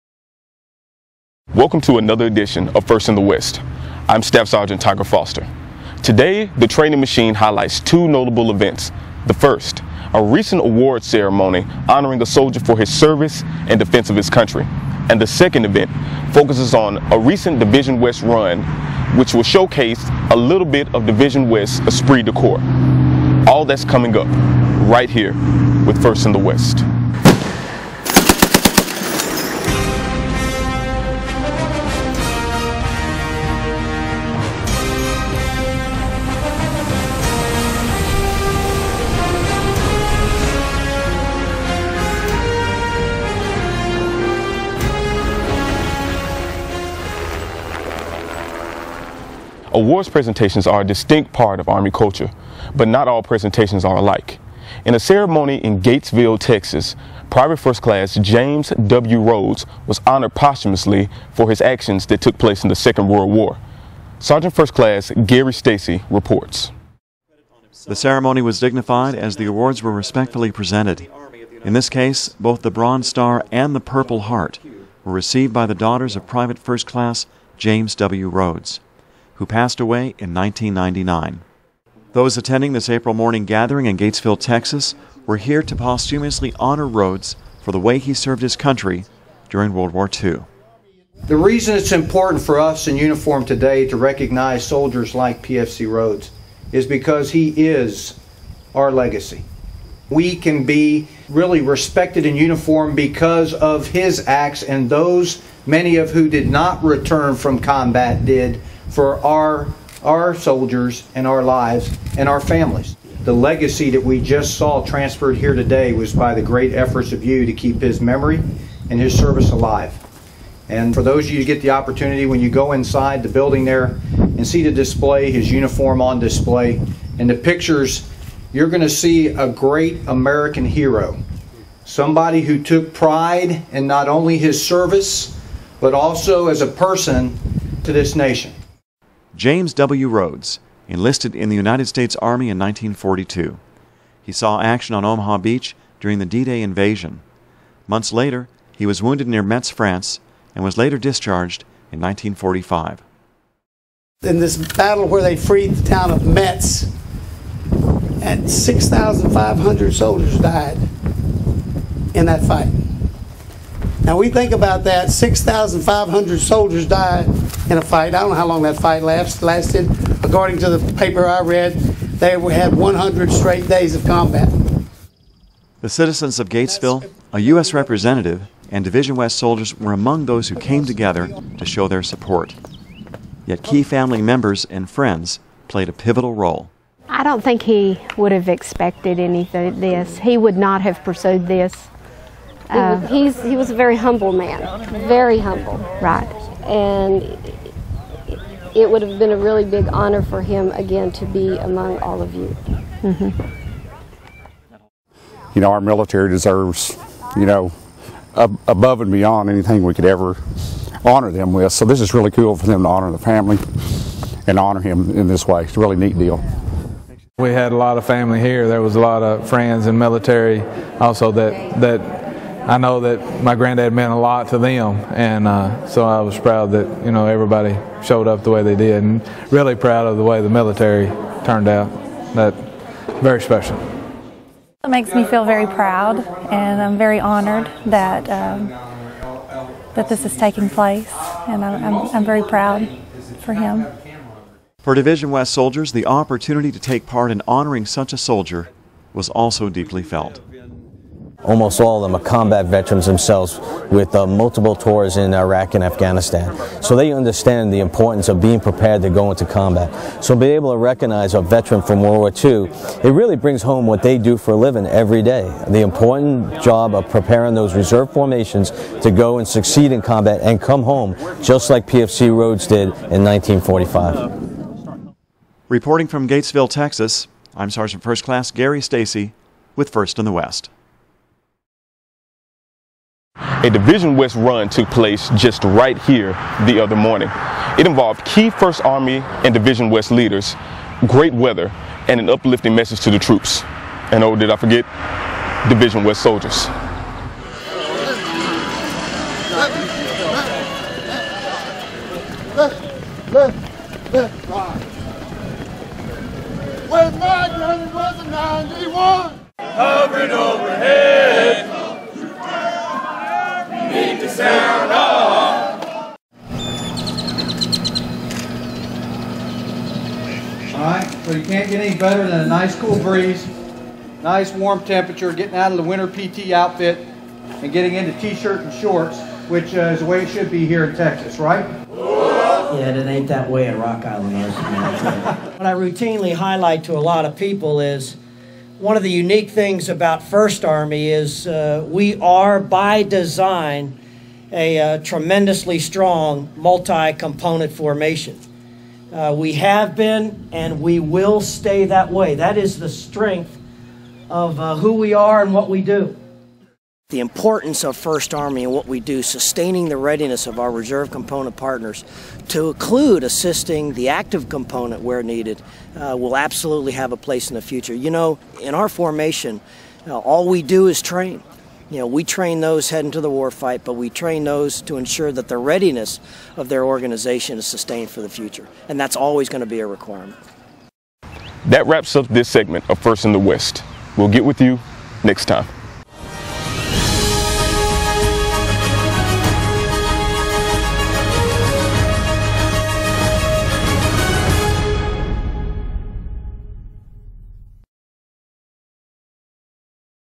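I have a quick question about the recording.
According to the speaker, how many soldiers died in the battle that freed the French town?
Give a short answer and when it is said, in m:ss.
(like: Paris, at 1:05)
6,500, at 2:38.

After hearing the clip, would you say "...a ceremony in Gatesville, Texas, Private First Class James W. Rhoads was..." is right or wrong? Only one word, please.
right.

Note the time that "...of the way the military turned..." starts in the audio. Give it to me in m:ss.
3:50.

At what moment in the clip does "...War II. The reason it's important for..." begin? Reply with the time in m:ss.
1:29.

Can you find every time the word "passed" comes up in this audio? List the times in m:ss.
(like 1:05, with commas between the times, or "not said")
1:19.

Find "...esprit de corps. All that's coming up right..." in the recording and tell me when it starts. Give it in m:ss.
0:21.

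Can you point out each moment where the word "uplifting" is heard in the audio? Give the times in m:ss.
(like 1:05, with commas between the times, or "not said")
4:52.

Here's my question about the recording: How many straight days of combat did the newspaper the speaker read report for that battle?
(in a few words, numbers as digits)
100.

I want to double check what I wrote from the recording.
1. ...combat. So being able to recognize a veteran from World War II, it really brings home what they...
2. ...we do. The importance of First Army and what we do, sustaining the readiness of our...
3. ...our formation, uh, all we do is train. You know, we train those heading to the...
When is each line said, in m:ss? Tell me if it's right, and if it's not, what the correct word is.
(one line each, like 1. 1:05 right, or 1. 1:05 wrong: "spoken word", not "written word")
1. 4:19 right
2. 5:55 right
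3. 6:08 right.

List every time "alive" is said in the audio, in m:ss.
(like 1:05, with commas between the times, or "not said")
1:59.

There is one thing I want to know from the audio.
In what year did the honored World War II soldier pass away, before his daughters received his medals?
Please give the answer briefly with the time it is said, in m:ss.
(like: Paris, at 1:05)
1999, at 1:20.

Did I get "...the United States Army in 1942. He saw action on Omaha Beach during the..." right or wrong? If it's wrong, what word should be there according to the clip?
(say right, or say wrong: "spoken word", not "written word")
right.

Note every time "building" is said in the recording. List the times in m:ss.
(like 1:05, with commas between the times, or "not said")
2:03.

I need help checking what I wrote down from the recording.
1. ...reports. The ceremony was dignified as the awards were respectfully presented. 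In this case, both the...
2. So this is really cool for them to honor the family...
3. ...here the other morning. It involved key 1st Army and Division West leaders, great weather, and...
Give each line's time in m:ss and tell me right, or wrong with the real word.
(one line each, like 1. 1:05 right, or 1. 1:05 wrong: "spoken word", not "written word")
1. 1:06 right
2. 3:31 right
3. 4:46 right.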